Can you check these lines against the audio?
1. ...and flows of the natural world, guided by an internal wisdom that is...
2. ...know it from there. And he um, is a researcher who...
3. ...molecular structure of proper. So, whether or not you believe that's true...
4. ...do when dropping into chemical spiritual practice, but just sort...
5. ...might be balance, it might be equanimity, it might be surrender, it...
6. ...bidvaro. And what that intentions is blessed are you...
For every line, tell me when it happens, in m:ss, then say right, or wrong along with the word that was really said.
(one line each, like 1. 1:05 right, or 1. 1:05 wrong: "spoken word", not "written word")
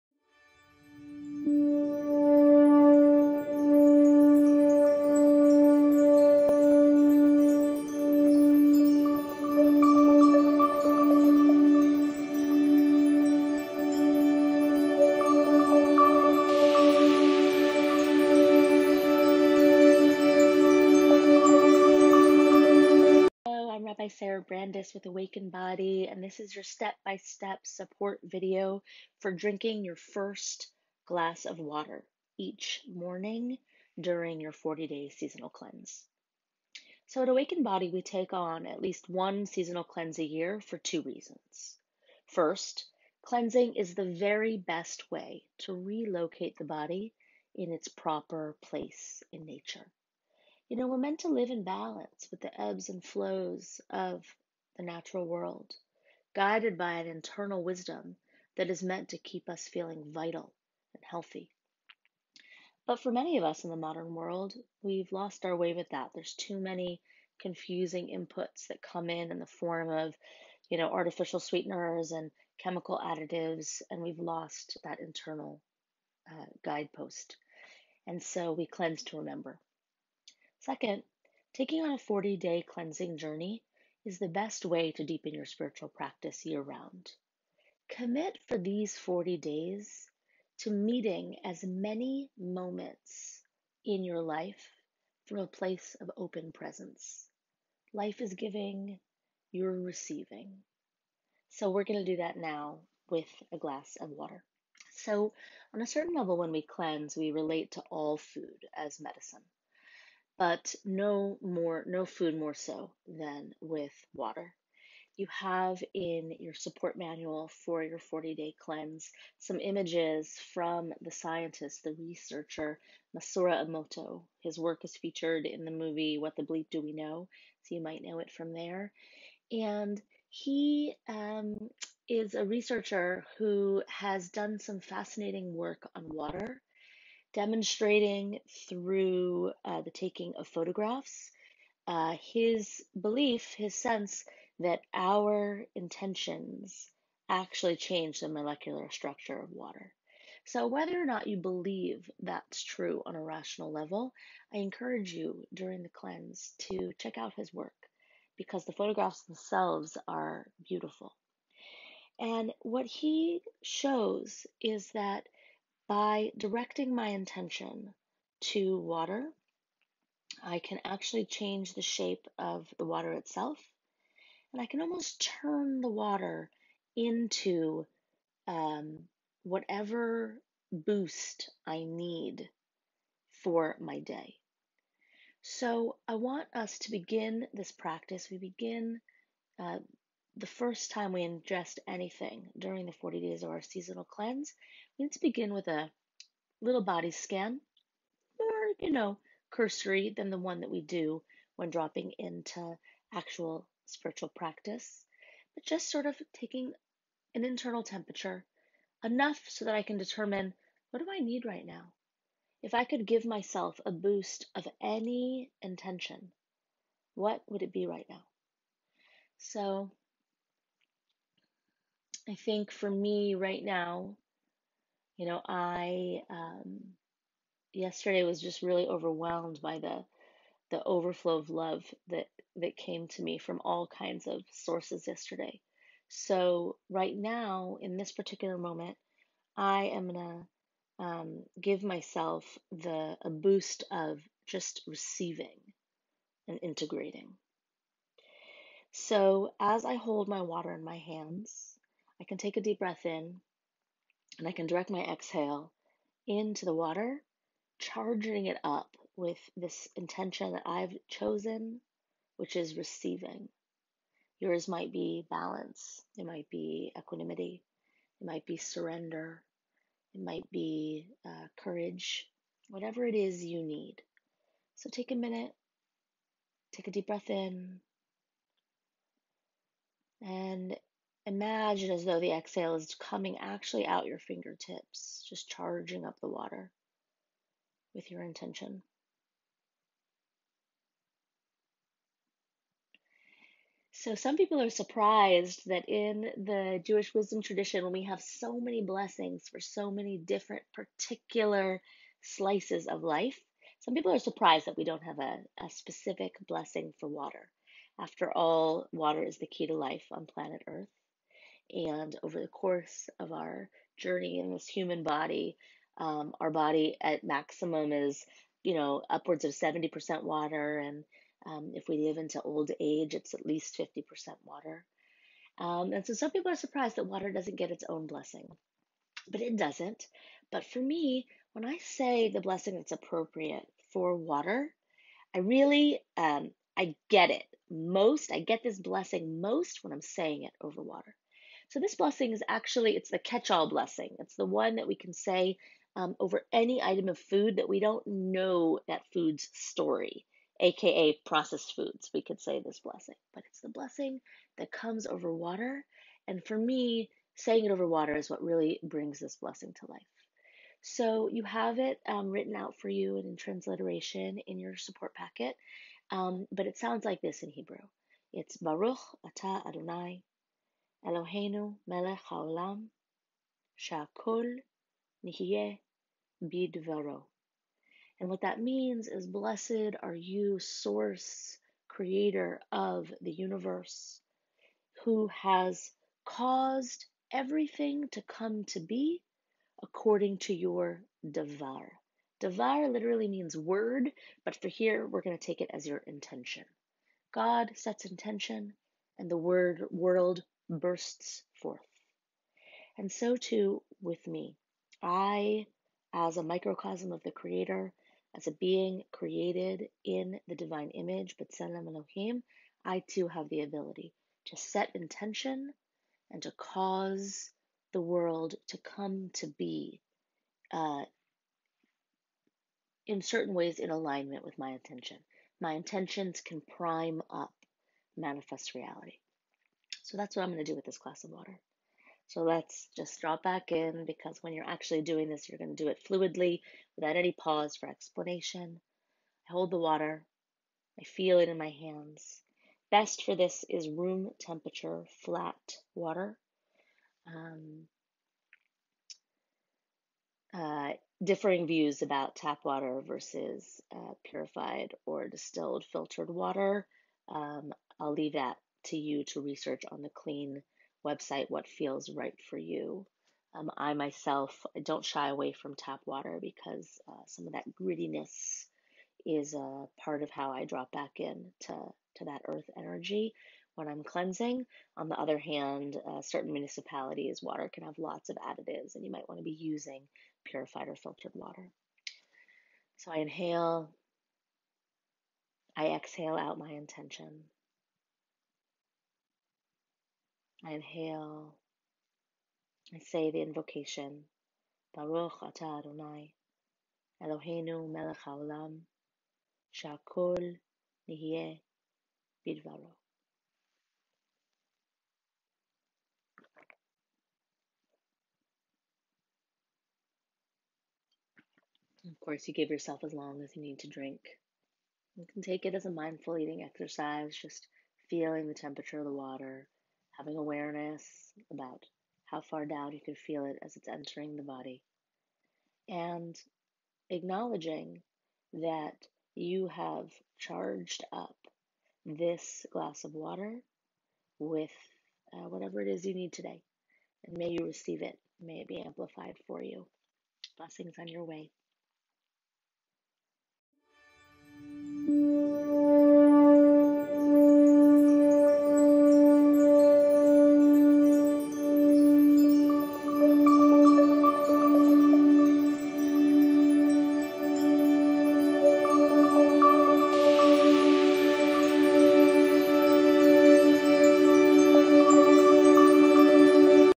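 1. 0:52 right
2. 2:08 right
3. 2:28 wrong: "water", not "proper"
4. 3:20 wrong: "actual", not "chemical"
5. 4:24 right
6. 6:16 wrong: "means", not "intentions".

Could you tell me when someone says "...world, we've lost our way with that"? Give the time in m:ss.
1:04.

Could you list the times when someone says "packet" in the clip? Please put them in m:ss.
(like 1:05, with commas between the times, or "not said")
6:05.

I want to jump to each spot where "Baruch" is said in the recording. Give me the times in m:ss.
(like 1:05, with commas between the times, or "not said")
6:08, 8:14.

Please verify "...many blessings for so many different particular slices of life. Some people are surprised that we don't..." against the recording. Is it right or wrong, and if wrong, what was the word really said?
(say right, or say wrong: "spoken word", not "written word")
right.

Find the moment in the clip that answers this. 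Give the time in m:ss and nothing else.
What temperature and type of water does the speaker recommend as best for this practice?
7:23.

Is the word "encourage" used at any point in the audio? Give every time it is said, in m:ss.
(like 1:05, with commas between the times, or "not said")
2:34.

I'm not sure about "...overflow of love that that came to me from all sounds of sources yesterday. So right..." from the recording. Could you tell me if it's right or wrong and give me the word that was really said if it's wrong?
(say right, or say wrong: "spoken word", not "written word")
wrong: "kinds", not "sounds".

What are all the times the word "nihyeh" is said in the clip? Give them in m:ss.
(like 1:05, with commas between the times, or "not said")
6:15, 8:21.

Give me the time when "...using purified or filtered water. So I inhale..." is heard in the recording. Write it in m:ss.
7:59.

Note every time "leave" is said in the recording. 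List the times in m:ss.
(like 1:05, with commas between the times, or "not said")
7:38.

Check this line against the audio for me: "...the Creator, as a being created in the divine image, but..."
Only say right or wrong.
right.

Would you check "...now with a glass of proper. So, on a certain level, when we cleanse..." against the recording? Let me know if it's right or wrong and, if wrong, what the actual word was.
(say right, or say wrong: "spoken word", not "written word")
wrong: "water", not "proper".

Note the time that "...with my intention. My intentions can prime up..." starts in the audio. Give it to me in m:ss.
7:04.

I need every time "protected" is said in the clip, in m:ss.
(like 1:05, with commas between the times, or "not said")
not said.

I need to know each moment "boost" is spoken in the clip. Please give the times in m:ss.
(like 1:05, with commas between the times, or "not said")
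3:00, 3:33, 4:03.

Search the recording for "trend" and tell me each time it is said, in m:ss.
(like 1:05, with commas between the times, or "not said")
not said.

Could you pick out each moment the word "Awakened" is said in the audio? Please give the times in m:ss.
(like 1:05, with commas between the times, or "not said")
0:25, 0:37.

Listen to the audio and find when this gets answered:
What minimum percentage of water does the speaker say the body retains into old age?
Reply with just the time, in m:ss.
5:23.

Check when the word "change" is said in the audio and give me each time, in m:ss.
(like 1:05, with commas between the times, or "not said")
2:27, 2:51.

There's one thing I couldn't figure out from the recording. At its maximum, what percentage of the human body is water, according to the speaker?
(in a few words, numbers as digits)
70%.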